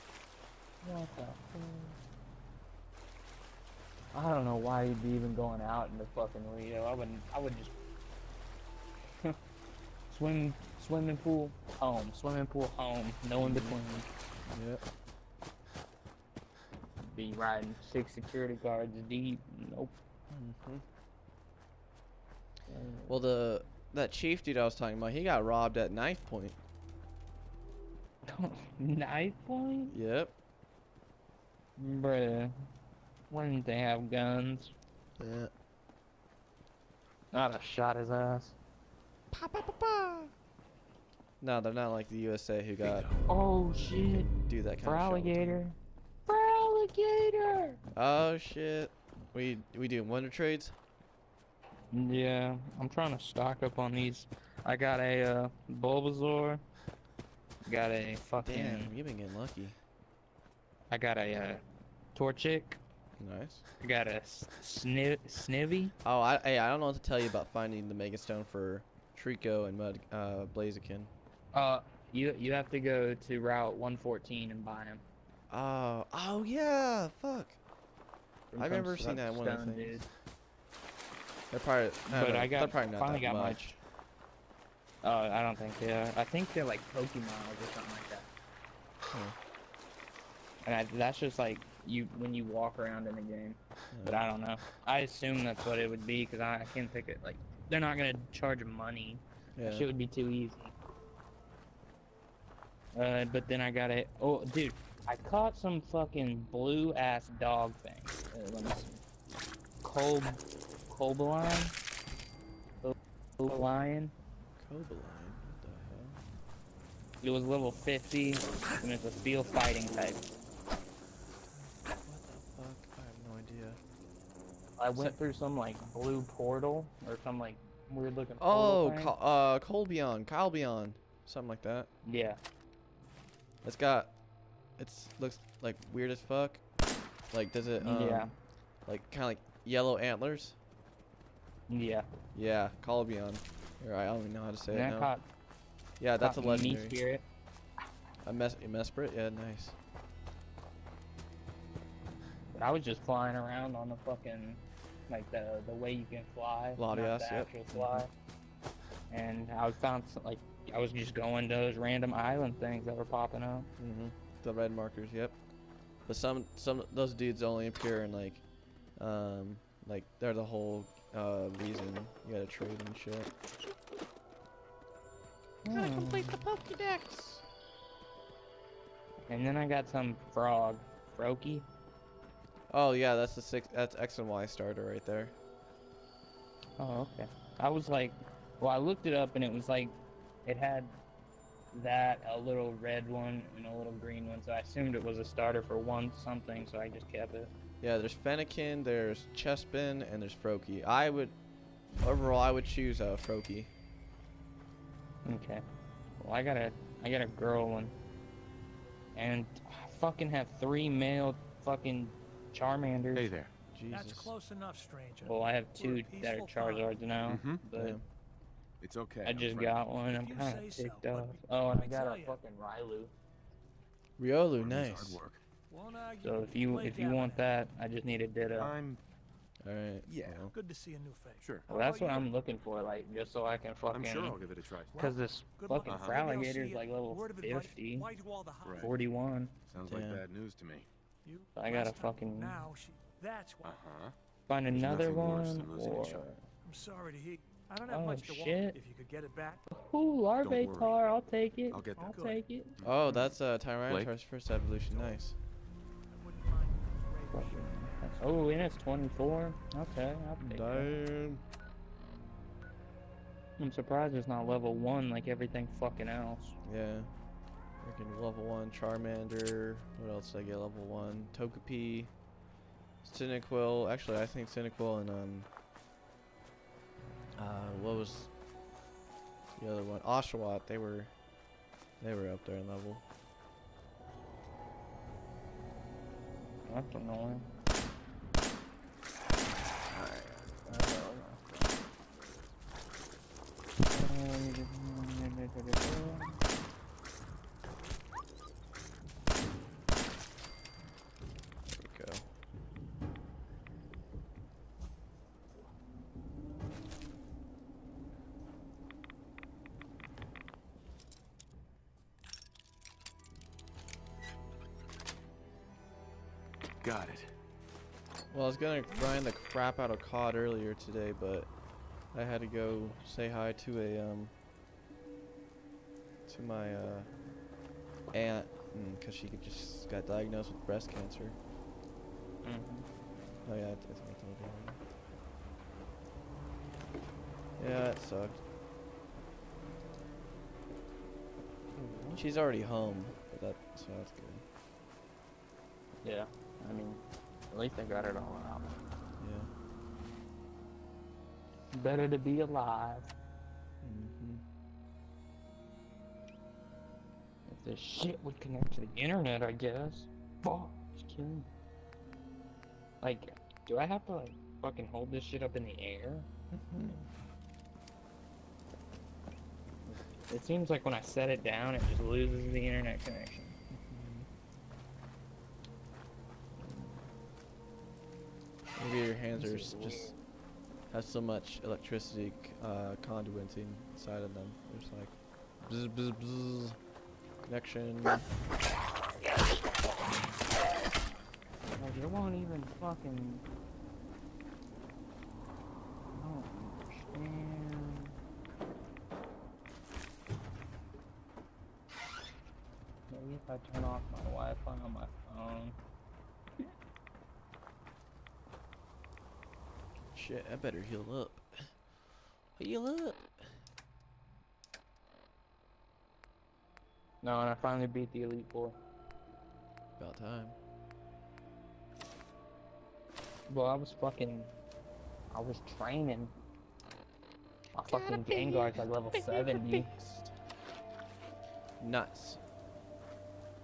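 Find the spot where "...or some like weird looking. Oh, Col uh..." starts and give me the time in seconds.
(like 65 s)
127 s.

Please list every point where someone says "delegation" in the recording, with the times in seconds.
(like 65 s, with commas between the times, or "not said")
not said.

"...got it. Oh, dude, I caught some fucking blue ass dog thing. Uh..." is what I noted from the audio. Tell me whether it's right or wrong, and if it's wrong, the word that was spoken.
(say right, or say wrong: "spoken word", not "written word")
right.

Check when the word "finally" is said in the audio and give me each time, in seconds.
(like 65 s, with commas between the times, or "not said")
83 s, 417 s.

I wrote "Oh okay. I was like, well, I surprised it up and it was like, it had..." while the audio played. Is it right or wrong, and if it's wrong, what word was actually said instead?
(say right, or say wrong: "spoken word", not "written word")
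wrong: "looked", not "surprised".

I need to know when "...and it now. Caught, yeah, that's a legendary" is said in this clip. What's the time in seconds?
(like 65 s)
144 s.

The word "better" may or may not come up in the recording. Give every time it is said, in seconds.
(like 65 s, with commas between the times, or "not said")
351 s, 410 s.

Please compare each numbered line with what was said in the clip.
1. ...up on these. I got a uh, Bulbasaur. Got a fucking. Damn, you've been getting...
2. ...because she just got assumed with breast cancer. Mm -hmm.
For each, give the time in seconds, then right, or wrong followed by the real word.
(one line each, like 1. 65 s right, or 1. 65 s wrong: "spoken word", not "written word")
1. 53 s right
2. 328 s wrong: "diagnosed", not "assumed".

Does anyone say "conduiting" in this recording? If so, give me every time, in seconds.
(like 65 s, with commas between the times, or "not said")
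383 s.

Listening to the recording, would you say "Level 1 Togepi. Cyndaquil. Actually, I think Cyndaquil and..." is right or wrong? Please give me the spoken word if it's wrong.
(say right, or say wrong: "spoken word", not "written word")
right.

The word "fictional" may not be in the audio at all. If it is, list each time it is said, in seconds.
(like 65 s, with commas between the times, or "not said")
not said.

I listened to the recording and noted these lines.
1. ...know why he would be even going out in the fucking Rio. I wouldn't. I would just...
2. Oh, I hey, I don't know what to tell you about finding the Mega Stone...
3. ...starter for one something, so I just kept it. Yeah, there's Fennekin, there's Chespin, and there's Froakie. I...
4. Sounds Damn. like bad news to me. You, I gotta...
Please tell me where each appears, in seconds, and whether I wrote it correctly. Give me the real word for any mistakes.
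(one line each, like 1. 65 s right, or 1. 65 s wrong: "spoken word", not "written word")
1. 4 s right
2. 66 s right
3. 195 s right
4. 239 s right.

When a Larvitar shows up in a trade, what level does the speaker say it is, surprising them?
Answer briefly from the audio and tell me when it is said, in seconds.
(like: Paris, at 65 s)
24, at 258 s.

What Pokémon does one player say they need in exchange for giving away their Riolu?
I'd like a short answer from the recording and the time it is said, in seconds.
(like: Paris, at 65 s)
Ditto, at 228 s.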